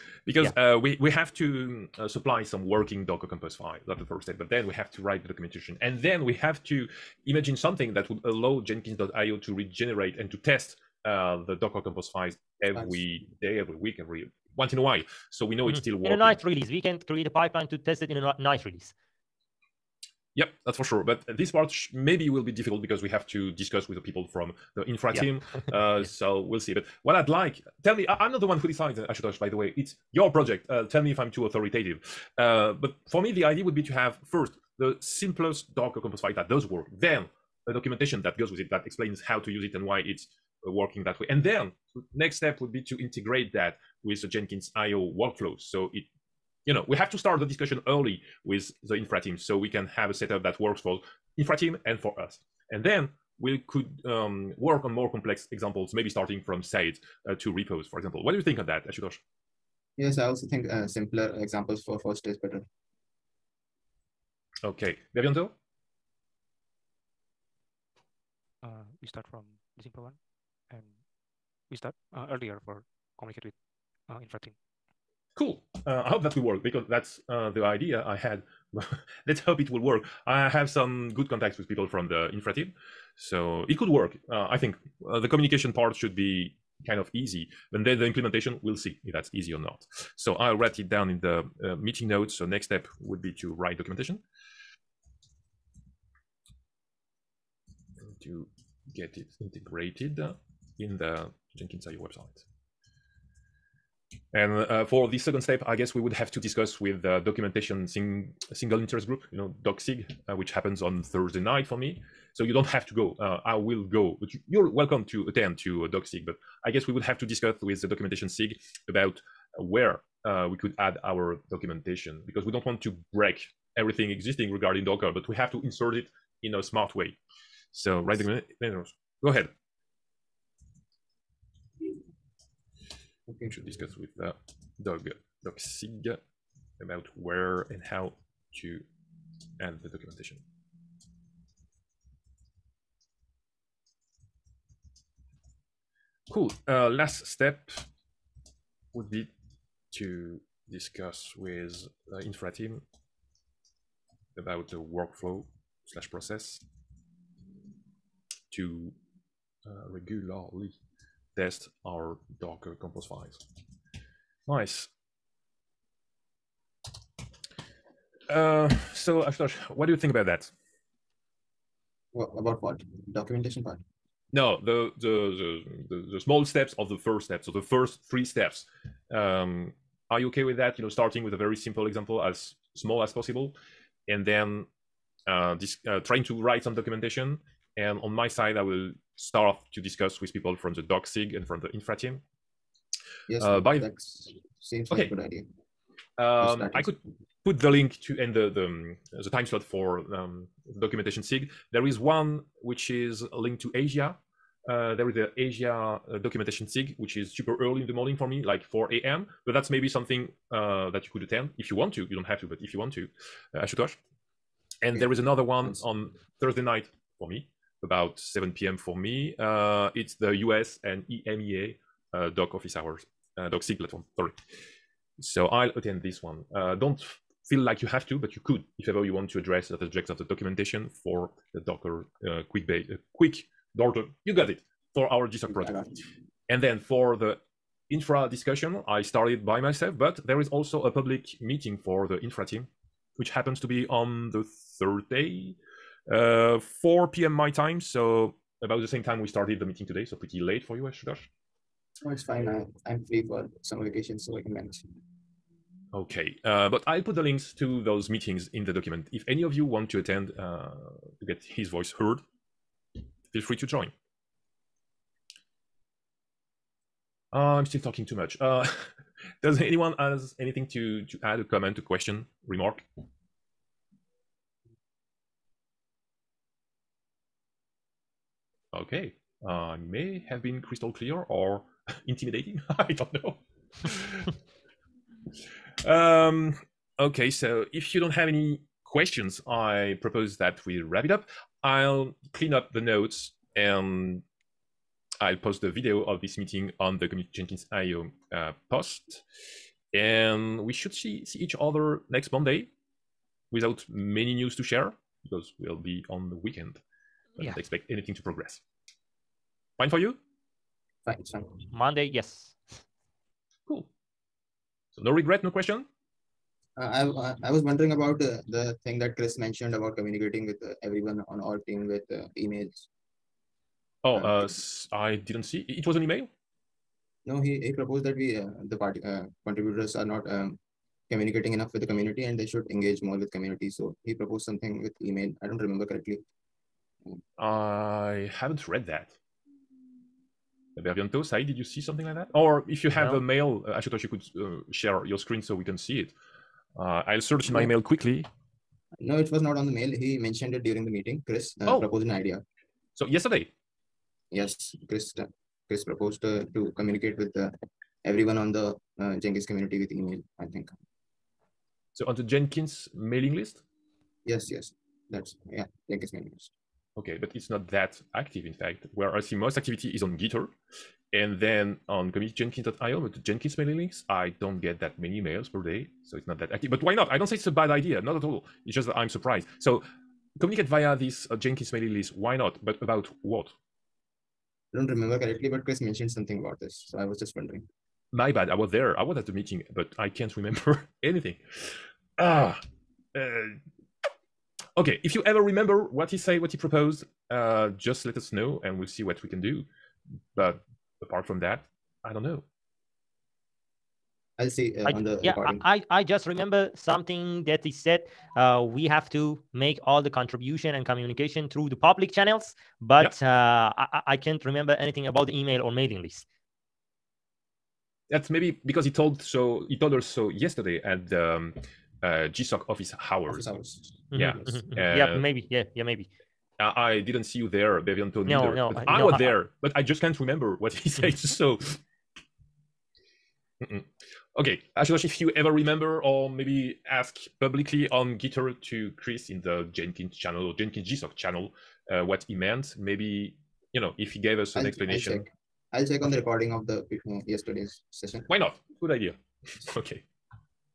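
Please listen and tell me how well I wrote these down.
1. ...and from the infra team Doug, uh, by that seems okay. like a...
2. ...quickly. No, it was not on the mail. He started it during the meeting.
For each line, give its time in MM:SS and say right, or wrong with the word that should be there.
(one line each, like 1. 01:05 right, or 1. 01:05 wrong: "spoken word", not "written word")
1. 03:11 wrong: "Yes", not "Doug"
2. 05:47 wrong: "mentioned", not "started".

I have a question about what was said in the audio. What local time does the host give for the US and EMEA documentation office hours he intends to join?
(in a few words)
7 p.m.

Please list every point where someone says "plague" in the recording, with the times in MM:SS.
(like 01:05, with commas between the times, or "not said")
not said.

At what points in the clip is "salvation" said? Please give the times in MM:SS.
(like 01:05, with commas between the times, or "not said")
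not said.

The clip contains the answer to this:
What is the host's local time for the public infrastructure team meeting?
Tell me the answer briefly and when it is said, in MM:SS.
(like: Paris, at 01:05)
4 p.m., at 04:06.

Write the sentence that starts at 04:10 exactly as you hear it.
So pretty late for you, Ashutosh.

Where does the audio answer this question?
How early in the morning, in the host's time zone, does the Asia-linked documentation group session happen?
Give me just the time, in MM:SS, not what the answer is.
03:28.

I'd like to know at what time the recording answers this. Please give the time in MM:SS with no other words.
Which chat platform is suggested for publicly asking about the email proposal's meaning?
07:18.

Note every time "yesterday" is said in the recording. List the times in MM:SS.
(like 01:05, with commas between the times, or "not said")
05:53, 07:00, 07:27.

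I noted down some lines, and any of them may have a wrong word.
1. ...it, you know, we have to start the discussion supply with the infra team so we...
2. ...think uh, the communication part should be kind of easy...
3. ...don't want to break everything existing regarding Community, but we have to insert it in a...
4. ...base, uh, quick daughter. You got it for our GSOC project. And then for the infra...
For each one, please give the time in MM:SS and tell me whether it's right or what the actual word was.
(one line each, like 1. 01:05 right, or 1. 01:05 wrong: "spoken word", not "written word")
1. 00:45 wrong: "early", not "supply"
2. 01:24 right
3. 02:02 wrong: "Docker", not "Community"
4. 03:52 right.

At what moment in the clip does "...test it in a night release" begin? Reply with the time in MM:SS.
00:17.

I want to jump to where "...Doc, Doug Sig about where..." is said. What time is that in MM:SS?
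02:14.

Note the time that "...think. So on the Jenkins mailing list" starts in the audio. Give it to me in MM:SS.
06:00.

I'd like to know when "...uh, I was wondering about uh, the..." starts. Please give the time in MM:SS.
05:17.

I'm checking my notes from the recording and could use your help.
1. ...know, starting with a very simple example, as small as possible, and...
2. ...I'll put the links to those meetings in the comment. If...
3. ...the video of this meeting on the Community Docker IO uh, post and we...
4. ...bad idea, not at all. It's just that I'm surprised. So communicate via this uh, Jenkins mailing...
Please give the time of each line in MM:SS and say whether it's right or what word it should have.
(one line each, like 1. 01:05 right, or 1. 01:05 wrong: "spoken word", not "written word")
1. 03:00 right
2. 04:16 wrong: "document", not "comment"
3. 04:55 wrong: "Jenkins", not "Docker"
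4. 06:17 right.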